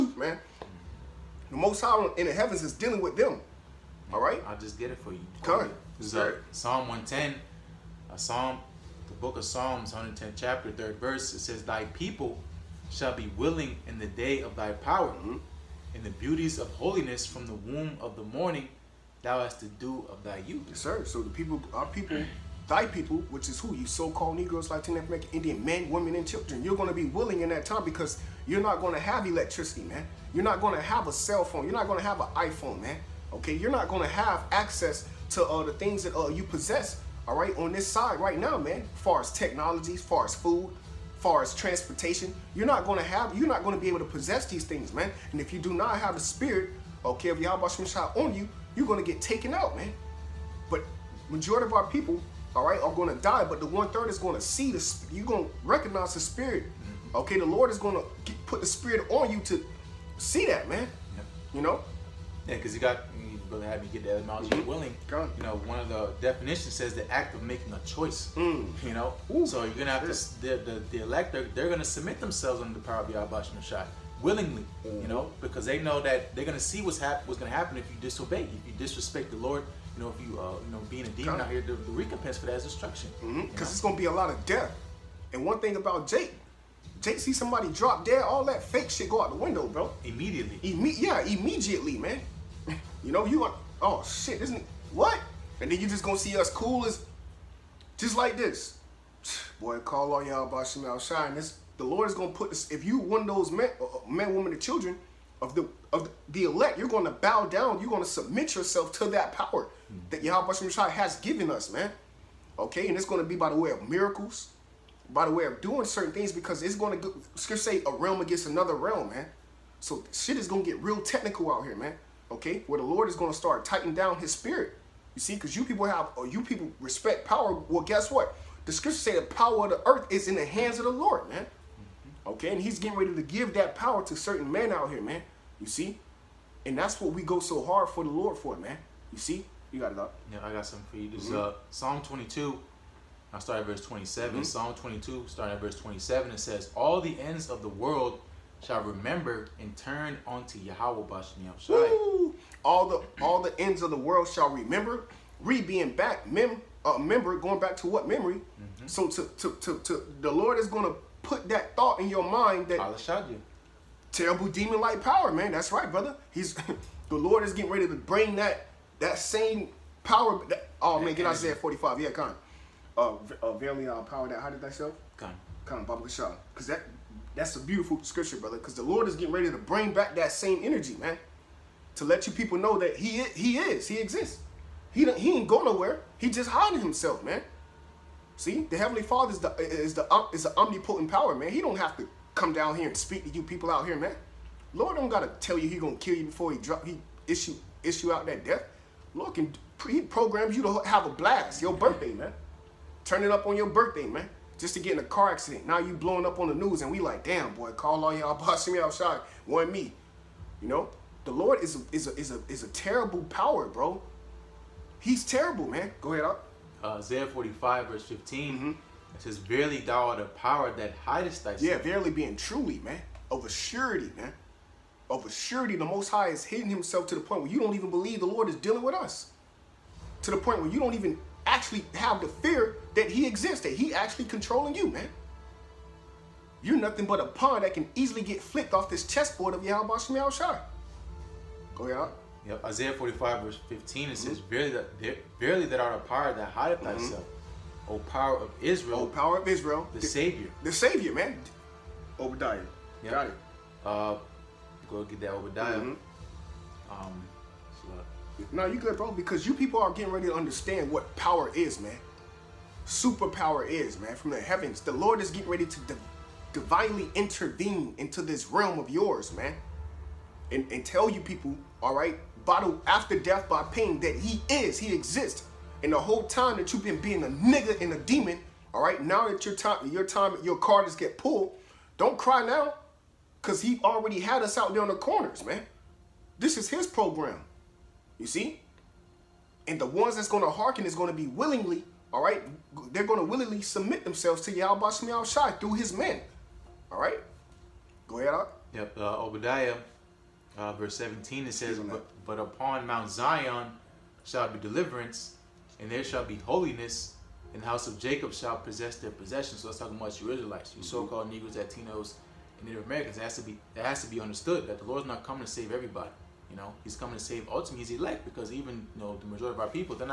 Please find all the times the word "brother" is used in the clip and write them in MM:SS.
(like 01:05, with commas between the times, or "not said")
02:45, 02:58.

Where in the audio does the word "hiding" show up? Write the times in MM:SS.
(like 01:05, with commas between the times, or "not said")
03:06.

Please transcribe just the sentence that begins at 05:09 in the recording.
So that's talking about the Israelites, you mm -hmm.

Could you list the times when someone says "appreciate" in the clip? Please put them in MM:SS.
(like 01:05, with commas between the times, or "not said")
not said.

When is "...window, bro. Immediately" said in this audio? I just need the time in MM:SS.
01:29.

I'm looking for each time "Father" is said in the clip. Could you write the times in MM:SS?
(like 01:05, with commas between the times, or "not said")
03:09.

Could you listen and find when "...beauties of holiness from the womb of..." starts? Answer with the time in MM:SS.
00:16.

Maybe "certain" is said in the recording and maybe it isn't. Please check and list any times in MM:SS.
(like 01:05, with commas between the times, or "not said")
01:55, 02:14.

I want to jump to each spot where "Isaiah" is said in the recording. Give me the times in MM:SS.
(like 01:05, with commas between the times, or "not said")
02:51, 03:36, 04:02.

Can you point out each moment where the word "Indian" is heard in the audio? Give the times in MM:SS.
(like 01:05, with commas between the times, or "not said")
00:25.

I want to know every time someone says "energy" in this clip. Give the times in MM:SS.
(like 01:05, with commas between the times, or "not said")
03:00.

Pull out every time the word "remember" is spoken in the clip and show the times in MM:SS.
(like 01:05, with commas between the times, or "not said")
02:28, 02:34.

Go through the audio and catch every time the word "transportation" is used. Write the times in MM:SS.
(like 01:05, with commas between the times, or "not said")
00:41.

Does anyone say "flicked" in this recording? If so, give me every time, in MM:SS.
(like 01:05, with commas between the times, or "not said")
03:58.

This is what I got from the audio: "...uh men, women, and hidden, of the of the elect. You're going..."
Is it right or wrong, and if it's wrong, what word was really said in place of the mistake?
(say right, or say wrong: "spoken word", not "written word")
wrong: "children", not "hidden".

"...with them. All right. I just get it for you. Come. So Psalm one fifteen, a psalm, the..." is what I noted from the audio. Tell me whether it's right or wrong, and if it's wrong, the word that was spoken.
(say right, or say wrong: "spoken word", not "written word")
wrong: "ten", not "fifteen".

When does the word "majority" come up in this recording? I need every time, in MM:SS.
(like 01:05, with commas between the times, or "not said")
00:51, 05:19.